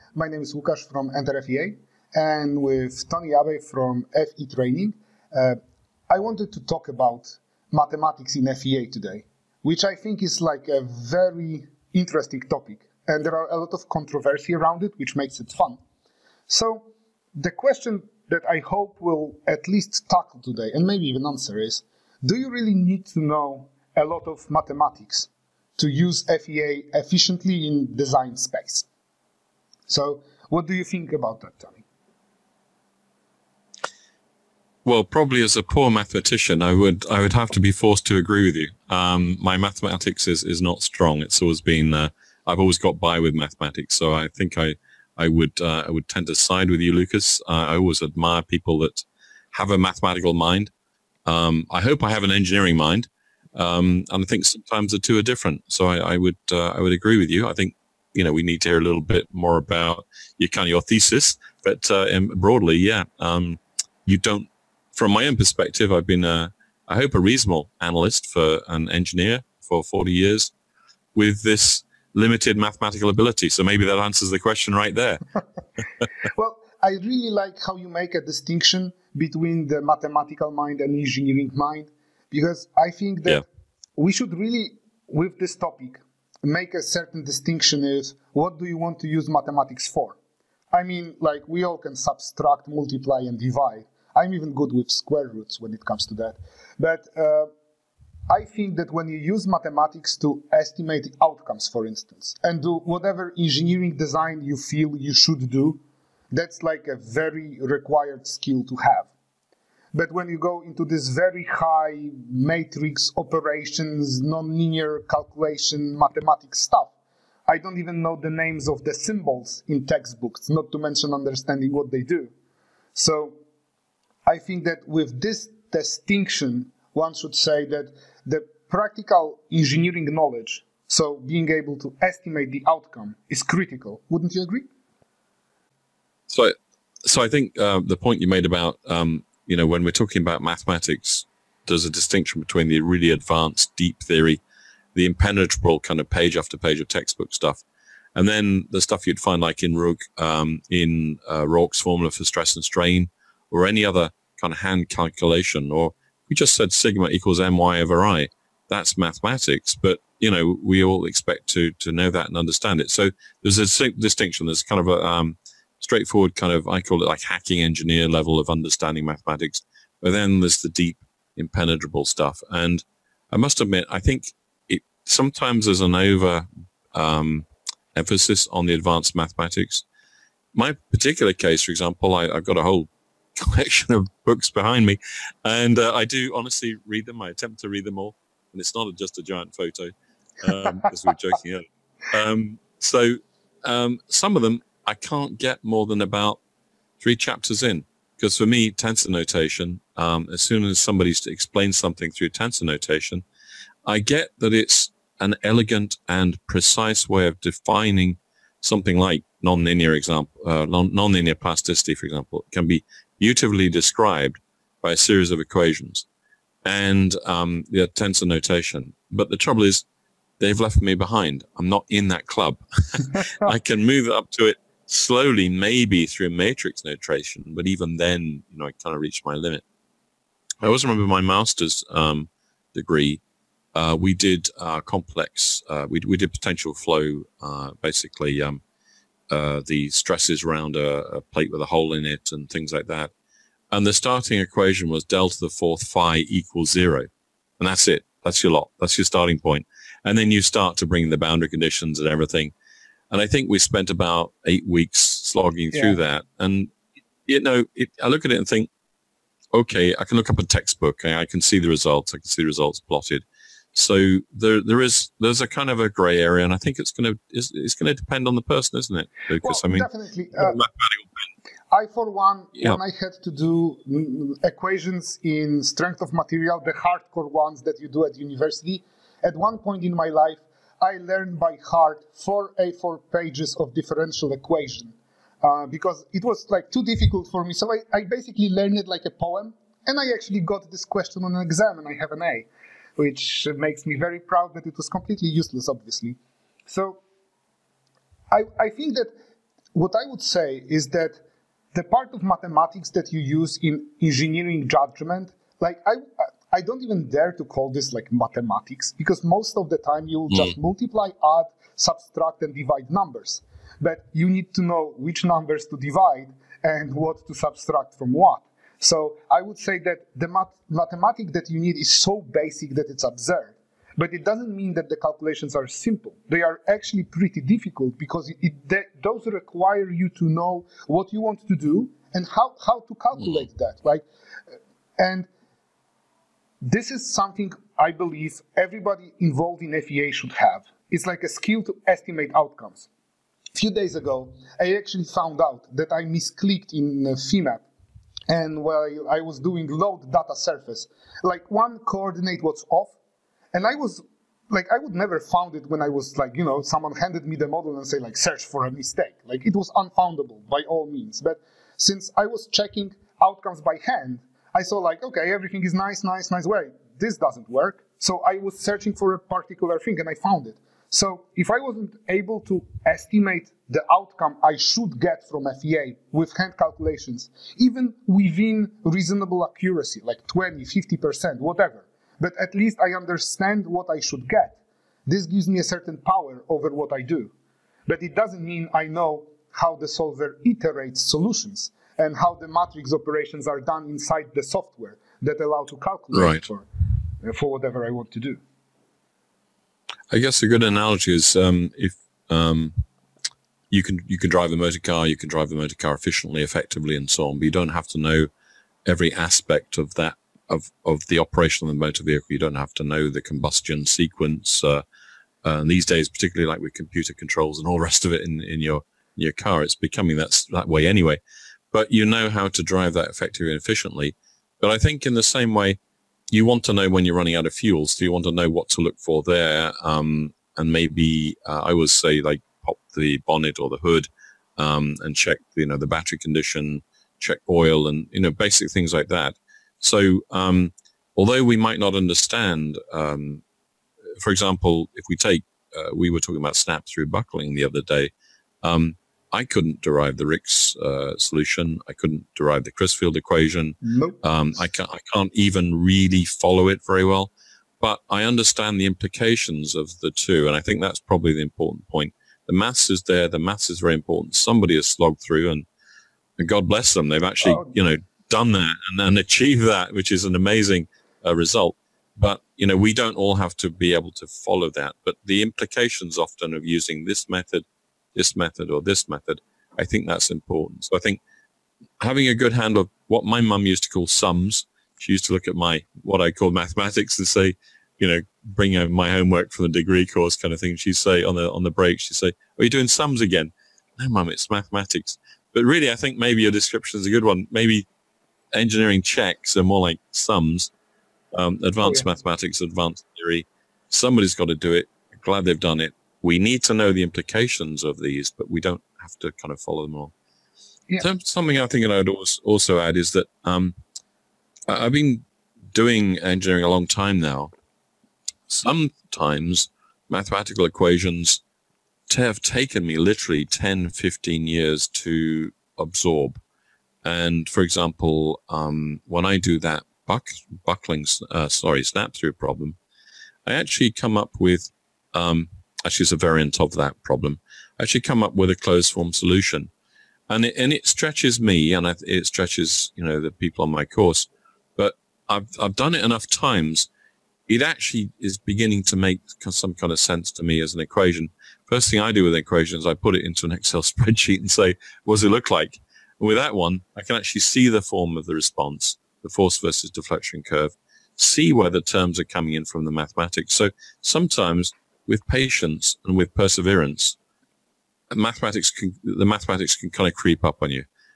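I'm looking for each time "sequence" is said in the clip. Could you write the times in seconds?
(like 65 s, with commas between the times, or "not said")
413 s.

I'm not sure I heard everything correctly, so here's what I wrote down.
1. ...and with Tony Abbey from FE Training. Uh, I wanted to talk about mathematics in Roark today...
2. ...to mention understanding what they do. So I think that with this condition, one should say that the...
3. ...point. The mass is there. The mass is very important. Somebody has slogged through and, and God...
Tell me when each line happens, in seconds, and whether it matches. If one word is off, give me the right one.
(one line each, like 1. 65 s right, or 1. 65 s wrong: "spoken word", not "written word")
1. 2 s wrong: "FEA", not "Roark"
2. 120 s wrong: "distinction", not "condition"
3. 461 s right.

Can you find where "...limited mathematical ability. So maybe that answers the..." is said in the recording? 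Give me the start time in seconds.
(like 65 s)
72 s.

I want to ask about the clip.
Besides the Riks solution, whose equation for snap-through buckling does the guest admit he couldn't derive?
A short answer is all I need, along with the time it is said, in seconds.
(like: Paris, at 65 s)
Crisfield, at 452 s.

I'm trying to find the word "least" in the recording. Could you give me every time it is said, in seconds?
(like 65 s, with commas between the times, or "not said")
19 s, 382 s.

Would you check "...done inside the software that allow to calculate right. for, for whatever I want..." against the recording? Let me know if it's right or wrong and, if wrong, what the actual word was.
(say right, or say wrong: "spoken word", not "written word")
right.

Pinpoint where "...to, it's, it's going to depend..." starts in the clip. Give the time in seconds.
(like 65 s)
267 s.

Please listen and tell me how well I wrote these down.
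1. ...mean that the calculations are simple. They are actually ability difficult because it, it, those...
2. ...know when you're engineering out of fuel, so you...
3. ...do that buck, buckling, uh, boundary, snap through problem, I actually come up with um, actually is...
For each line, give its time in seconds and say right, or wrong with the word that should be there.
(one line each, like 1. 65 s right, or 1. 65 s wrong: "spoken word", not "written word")
1. 324 s wrong: "pretty", not "ability"
2. 426 s wrong: "running", not "engineering"
3. 529 s wrong: "sorry", not "boundary".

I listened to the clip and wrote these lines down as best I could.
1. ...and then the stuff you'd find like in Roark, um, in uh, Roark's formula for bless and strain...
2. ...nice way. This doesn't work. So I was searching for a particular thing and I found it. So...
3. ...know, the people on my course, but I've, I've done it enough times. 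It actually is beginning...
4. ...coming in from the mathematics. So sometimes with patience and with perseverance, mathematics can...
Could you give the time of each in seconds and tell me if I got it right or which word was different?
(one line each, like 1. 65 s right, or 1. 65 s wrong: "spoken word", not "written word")
1. 148 s wrong: "stress", not "bless"
2. 366 s right
3. 543 s right
4. 562 s right.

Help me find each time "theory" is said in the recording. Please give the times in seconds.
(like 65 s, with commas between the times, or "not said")
143 s, 503 s.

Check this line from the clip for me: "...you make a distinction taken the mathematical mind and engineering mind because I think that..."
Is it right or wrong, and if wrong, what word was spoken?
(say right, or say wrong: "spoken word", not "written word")
wrong: "between", not "taken".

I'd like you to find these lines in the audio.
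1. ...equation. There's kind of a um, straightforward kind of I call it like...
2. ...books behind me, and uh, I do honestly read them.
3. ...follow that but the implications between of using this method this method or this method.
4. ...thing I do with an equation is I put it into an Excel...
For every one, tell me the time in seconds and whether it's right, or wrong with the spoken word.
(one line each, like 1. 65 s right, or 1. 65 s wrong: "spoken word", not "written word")
1. 163 s wrong: "distinction", not "equation"
2. 184 s right
3. 474 s wrong: "often", not "between"
4. 551 s right.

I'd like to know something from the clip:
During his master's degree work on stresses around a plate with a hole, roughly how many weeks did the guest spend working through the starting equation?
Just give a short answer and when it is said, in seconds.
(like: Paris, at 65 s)
8, at 254 s.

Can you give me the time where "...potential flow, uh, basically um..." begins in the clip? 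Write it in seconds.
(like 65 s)
236 s.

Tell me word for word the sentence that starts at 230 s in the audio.
I also remember my master's um, degree.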